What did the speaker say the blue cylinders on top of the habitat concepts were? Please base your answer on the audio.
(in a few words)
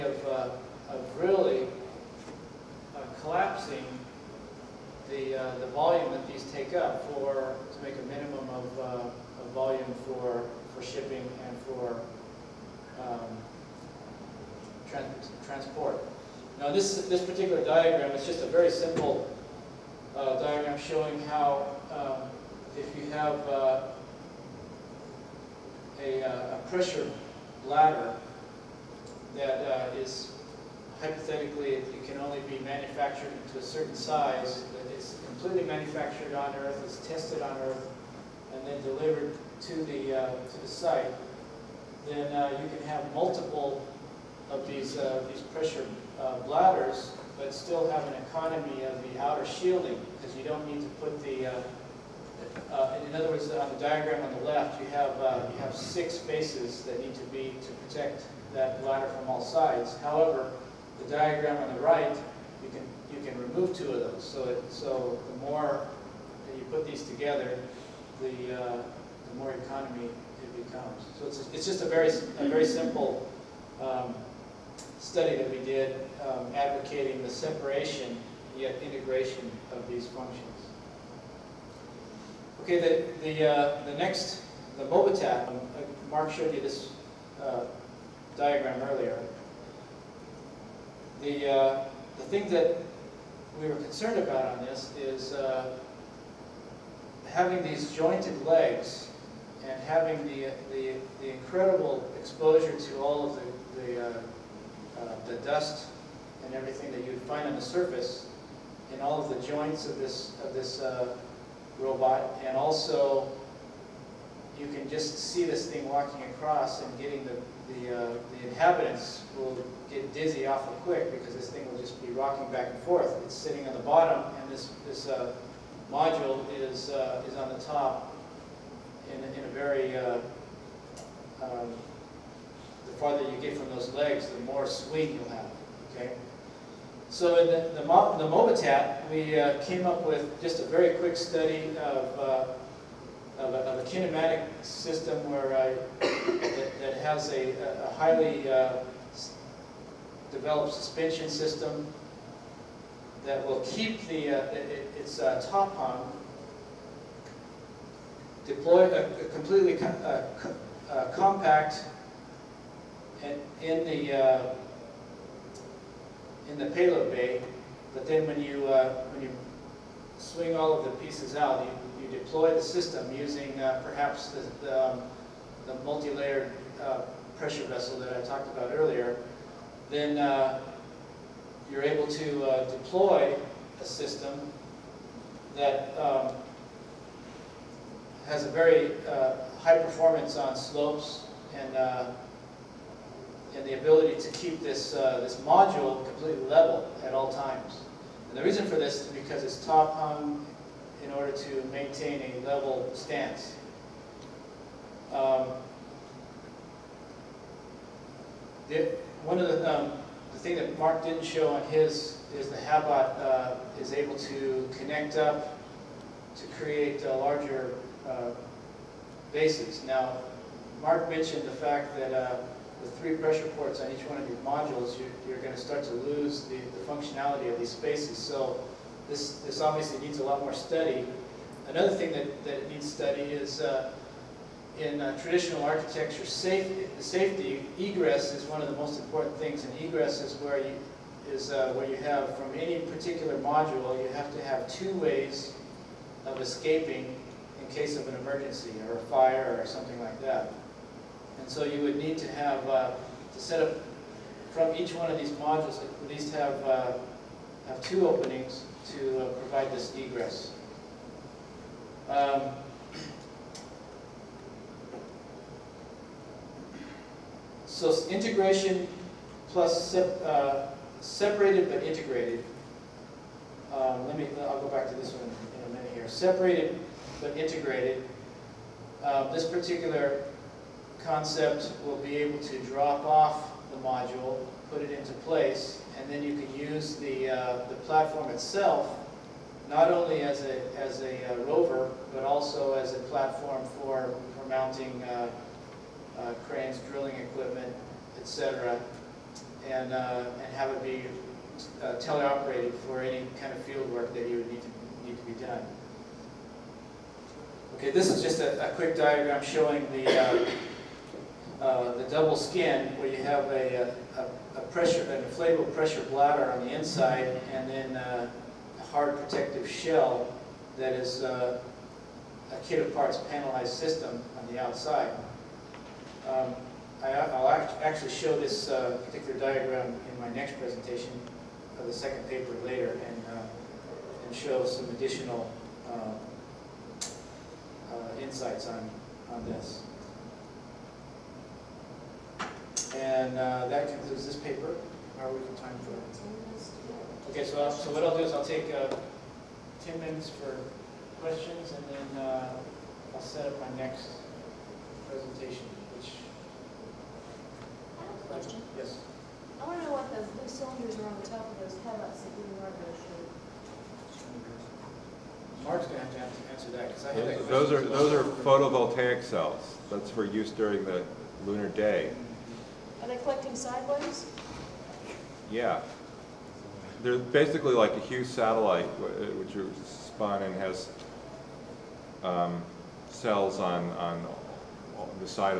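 Photovoltaic cells.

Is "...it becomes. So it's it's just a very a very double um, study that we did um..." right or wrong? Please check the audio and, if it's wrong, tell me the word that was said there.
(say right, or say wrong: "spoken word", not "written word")
wrong: "simple", not "double".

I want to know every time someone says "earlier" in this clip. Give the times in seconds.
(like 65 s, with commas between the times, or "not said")
88 s, 178 s.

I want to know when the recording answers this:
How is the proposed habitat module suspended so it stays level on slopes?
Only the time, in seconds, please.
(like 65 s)
199 s.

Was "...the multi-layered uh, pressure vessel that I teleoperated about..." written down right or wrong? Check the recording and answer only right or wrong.
wrong.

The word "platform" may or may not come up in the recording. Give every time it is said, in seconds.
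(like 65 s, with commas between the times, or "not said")
287 s, 293 s.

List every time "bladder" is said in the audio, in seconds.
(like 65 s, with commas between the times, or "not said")
27 s, 46 s, 58 s, 316 s.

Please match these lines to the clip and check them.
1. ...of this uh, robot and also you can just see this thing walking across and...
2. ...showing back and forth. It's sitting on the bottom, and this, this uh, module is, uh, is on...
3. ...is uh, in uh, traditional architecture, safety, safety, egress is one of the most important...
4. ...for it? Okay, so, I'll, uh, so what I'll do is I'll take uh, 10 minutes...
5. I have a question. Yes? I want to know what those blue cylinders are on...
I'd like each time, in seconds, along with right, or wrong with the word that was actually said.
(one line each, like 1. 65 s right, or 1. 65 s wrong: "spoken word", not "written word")
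1. 110 s right
2. 122 s wrong: "rocking", not "showing"
3. 233 s right
4. 345 s right
5. 357 s right.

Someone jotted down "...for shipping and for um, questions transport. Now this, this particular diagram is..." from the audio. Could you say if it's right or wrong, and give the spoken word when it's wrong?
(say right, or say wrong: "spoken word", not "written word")
wrong: "trans", not "questions".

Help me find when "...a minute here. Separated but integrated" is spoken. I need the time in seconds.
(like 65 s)
275 s.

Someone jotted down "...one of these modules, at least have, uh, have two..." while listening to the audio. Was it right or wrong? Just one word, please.
right.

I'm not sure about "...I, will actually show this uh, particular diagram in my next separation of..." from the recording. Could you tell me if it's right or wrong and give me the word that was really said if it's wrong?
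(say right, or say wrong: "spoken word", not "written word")
wrong: "presentation", not "separation".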